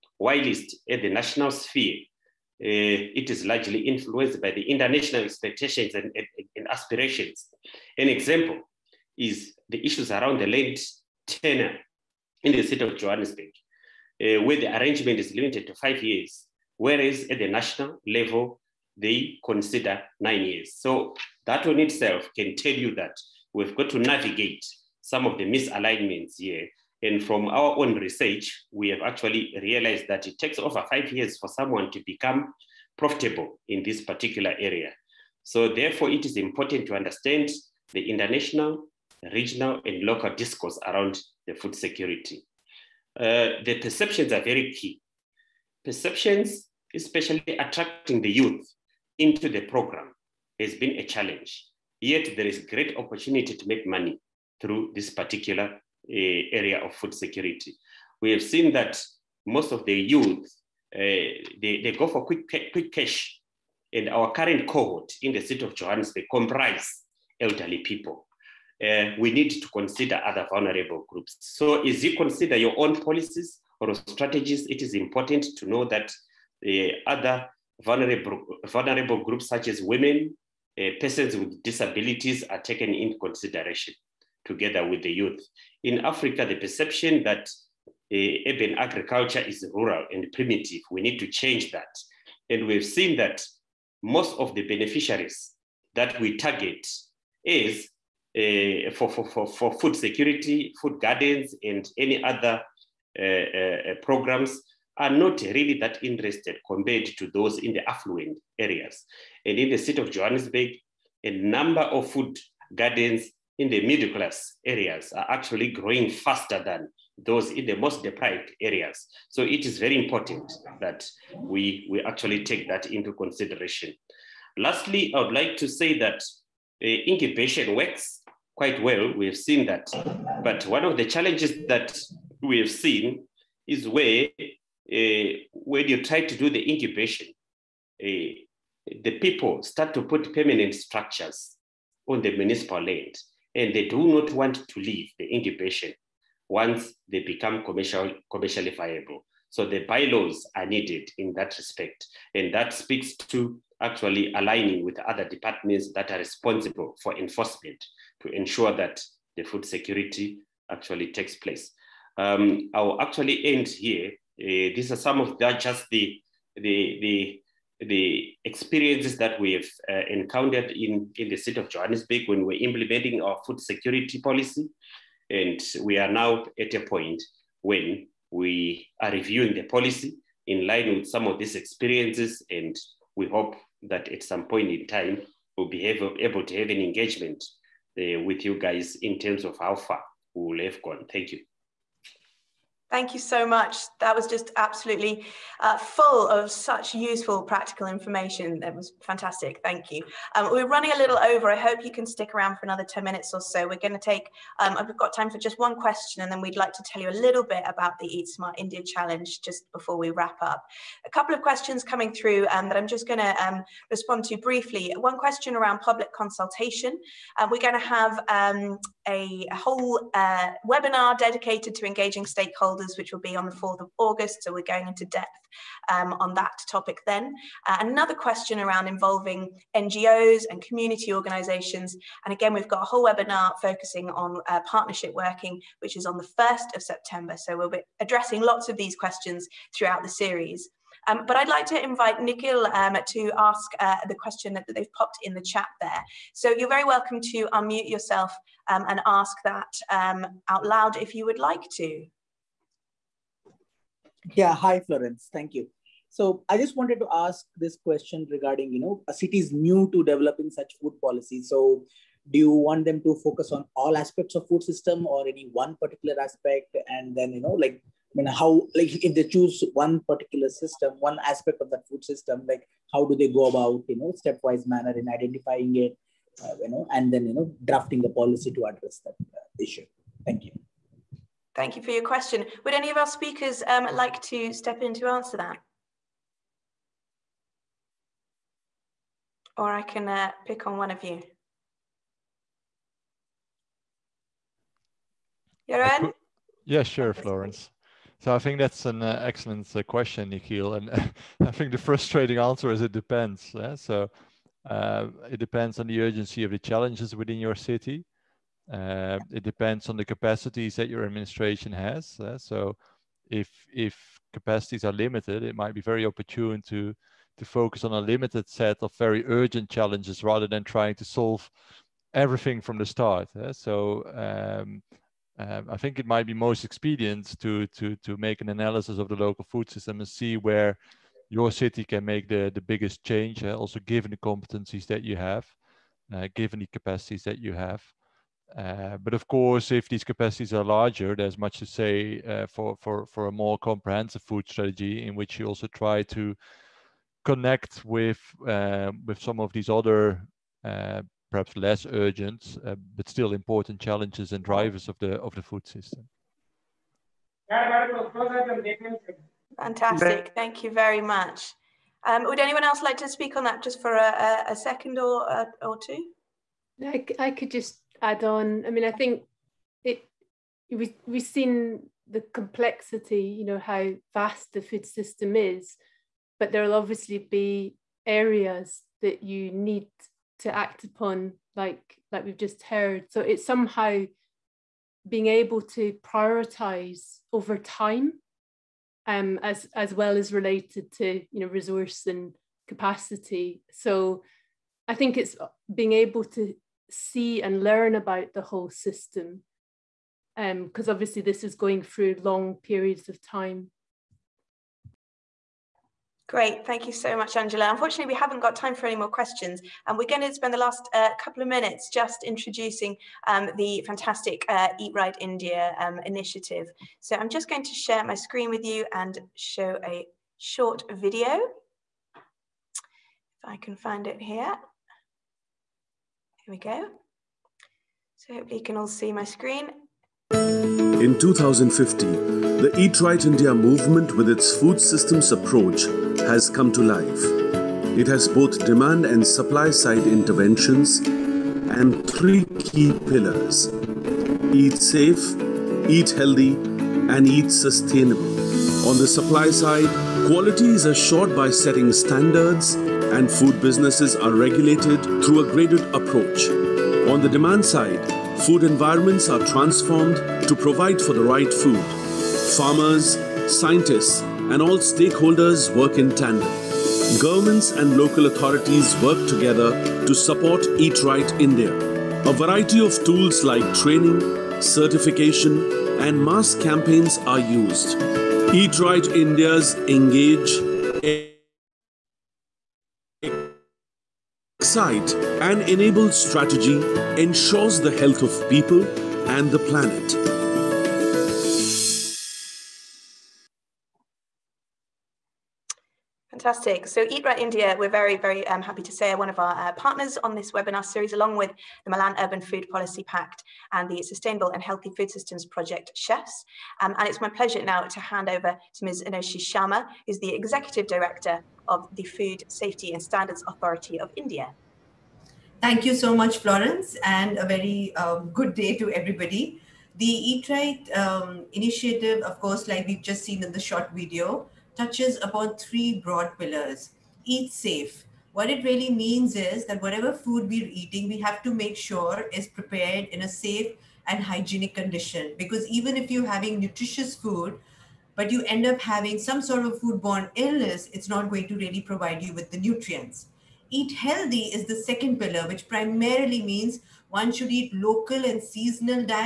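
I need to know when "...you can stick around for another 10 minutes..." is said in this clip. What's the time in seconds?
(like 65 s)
201 s.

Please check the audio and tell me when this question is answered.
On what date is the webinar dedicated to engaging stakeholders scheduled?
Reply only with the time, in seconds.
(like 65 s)
223 s.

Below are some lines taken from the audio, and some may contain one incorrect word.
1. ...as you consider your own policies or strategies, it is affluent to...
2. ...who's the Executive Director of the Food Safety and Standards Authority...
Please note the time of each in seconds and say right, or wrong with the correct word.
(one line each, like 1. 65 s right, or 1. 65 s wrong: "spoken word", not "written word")
1. 71 s wrong: "important", not "affluent"
2. 510 s right.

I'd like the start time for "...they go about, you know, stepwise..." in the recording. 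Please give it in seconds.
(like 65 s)
273 s.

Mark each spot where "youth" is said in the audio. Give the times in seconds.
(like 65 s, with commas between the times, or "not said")
48 s, 59 s, 85 s.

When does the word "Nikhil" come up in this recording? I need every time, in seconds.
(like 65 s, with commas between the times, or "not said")
242 s, 300 s.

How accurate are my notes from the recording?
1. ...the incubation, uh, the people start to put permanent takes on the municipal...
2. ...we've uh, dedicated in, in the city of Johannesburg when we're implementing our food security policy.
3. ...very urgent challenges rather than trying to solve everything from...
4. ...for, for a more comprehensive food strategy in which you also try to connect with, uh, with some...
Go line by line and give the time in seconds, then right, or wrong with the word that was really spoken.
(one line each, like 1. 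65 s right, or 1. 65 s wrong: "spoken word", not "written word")
1. 136 s wrong: "structures", not "takes"
2. 169 s wrong: "encountered", not "dedicated"
3. 318 s right
4. 342 s right.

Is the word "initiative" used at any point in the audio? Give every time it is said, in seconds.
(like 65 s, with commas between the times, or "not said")
416 s, 521 s.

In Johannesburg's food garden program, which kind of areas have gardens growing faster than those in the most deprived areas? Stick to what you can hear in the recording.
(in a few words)
Middle class areas.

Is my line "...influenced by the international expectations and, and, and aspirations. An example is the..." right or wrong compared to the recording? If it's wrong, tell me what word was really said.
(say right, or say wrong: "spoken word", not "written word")
right.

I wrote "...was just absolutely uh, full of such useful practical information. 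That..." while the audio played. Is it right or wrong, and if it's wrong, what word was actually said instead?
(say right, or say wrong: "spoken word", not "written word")
right.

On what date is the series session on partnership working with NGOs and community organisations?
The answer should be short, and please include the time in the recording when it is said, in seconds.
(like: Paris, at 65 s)
1st of September, at 236 s.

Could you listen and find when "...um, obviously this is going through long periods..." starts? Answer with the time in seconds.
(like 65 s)
400 s.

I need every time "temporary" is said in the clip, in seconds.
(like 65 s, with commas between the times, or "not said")
not said.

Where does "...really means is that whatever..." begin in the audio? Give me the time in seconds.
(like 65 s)
528 s.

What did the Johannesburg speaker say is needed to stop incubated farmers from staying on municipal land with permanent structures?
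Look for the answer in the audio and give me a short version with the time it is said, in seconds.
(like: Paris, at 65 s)
Bylaws, at 149 s.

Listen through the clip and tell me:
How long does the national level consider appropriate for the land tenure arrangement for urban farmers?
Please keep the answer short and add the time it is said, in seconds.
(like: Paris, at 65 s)
9 years, at 20 s.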